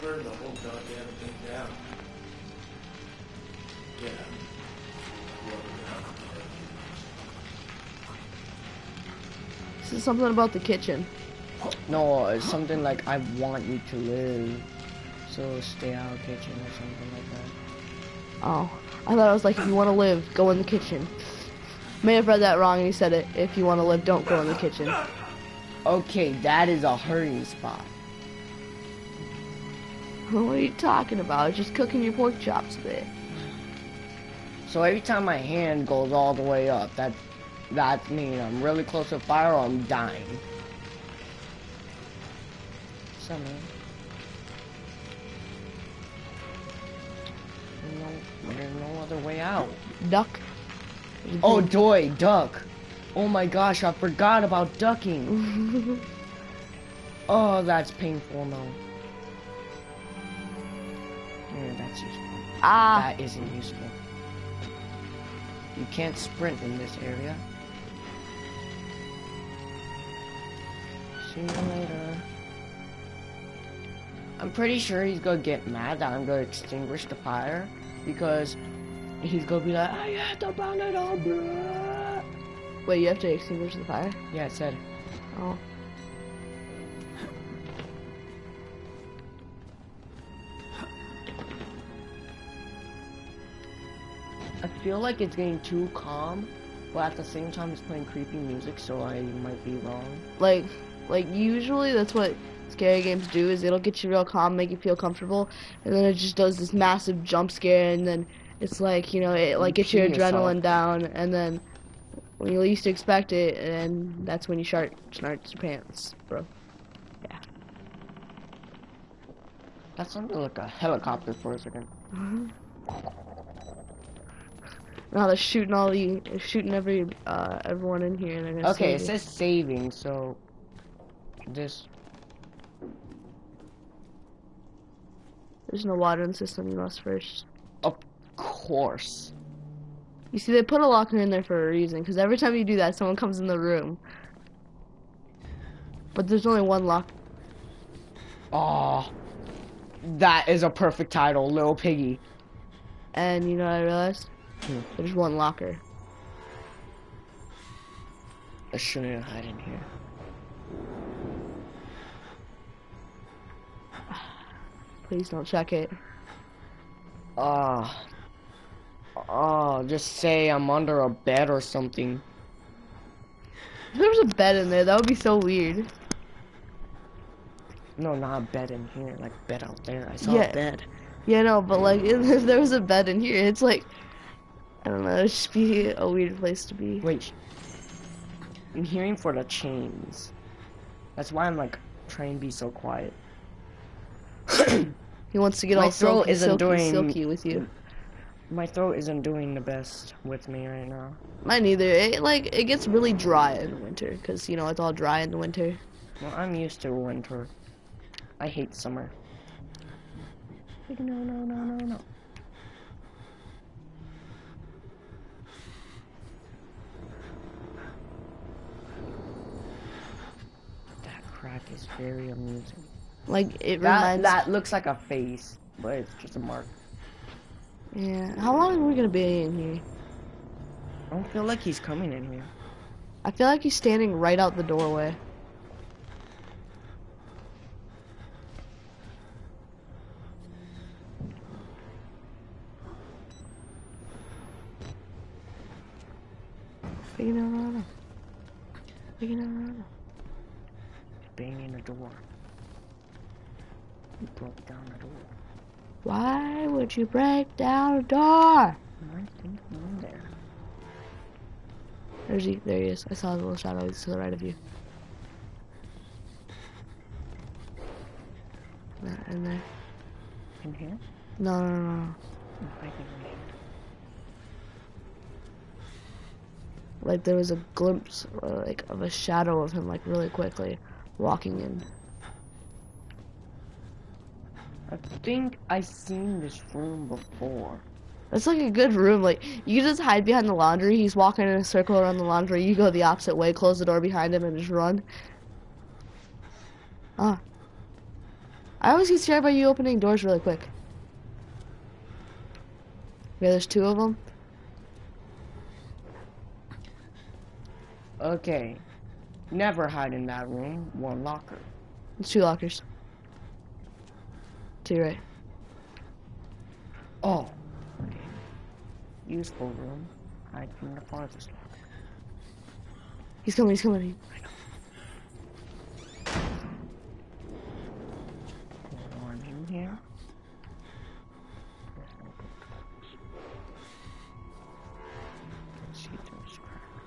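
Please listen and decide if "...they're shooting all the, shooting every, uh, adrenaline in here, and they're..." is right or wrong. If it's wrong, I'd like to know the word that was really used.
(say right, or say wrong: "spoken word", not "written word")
wrong: "everyone", not "adrenaline".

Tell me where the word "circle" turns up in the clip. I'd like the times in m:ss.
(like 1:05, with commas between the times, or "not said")
4:51.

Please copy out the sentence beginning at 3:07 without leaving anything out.
Wait, I'm hearing for the chains.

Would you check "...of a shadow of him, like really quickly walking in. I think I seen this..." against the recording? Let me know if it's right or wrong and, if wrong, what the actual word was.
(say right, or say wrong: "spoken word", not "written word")
right.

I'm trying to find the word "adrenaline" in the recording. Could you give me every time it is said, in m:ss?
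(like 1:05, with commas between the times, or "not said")
1:50.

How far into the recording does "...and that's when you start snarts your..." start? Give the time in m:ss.
1:53.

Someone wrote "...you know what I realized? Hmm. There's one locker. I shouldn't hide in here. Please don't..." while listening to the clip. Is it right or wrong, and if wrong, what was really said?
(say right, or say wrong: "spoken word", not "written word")
right.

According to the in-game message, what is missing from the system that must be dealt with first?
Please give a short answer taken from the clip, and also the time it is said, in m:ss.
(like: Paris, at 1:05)
Water, at 2:15.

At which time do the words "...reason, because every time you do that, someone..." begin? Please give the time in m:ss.
2:21.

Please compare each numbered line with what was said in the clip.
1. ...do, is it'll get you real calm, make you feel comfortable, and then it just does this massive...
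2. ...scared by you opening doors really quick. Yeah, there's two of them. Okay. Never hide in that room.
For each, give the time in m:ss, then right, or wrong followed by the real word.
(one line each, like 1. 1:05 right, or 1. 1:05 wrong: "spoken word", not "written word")
1. 1:43 right
2. 4:59 right.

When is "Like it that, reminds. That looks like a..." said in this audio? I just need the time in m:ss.
3:43.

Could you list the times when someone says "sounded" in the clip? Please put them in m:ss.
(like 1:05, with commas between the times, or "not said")
2:00.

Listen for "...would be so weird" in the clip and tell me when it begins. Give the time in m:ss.
2:54.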